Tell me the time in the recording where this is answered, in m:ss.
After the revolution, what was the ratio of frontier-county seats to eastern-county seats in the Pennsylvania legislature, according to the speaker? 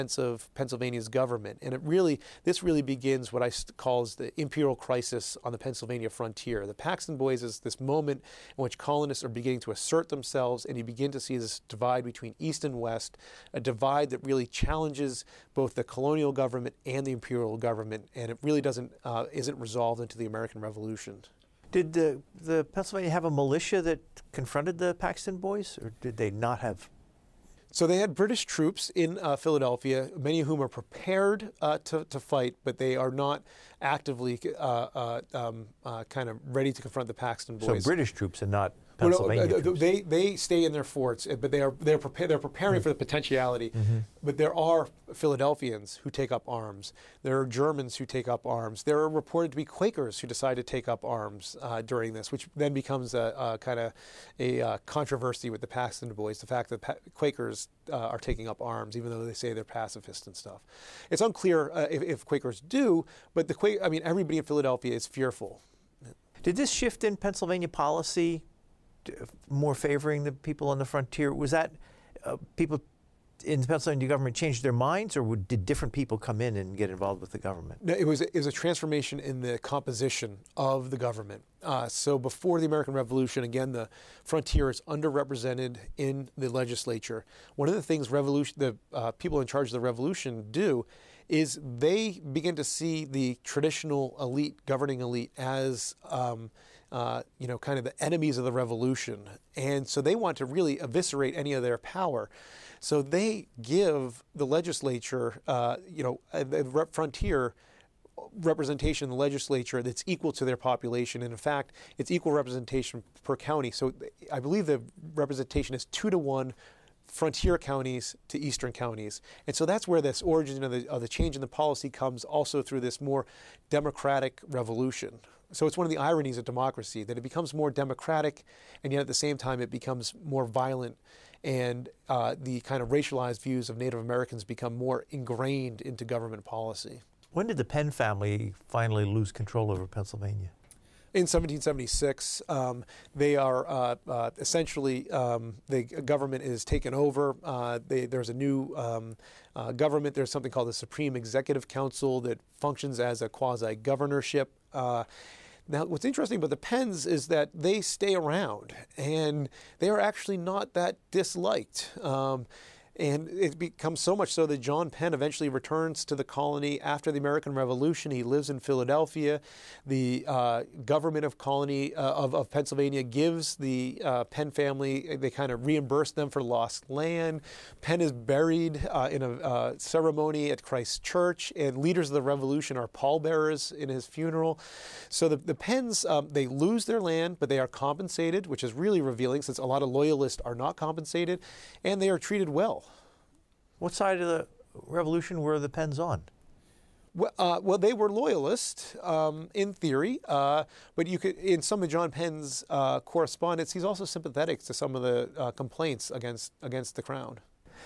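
1:55.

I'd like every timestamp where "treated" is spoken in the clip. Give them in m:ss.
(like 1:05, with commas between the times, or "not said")
3:12.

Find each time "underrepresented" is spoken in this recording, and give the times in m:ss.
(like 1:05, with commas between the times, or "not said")
1:24.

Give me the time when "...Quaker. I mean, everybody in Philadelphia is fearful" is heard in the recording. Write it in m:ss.
1:03.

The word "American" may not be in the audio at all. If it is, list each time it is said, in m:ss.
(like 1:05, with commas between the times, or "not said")
0:20, 1:22, 2:13, 2:47.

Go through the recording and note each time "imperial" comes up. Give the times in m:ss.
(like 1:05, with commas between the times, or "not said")
0:04, 0:17.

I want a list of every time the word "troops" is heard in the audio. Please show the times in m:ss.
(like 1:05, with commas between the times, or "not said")
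0:28, 0:38.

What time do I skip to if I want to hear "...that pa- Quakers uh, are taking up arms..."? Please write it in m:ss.
0:56.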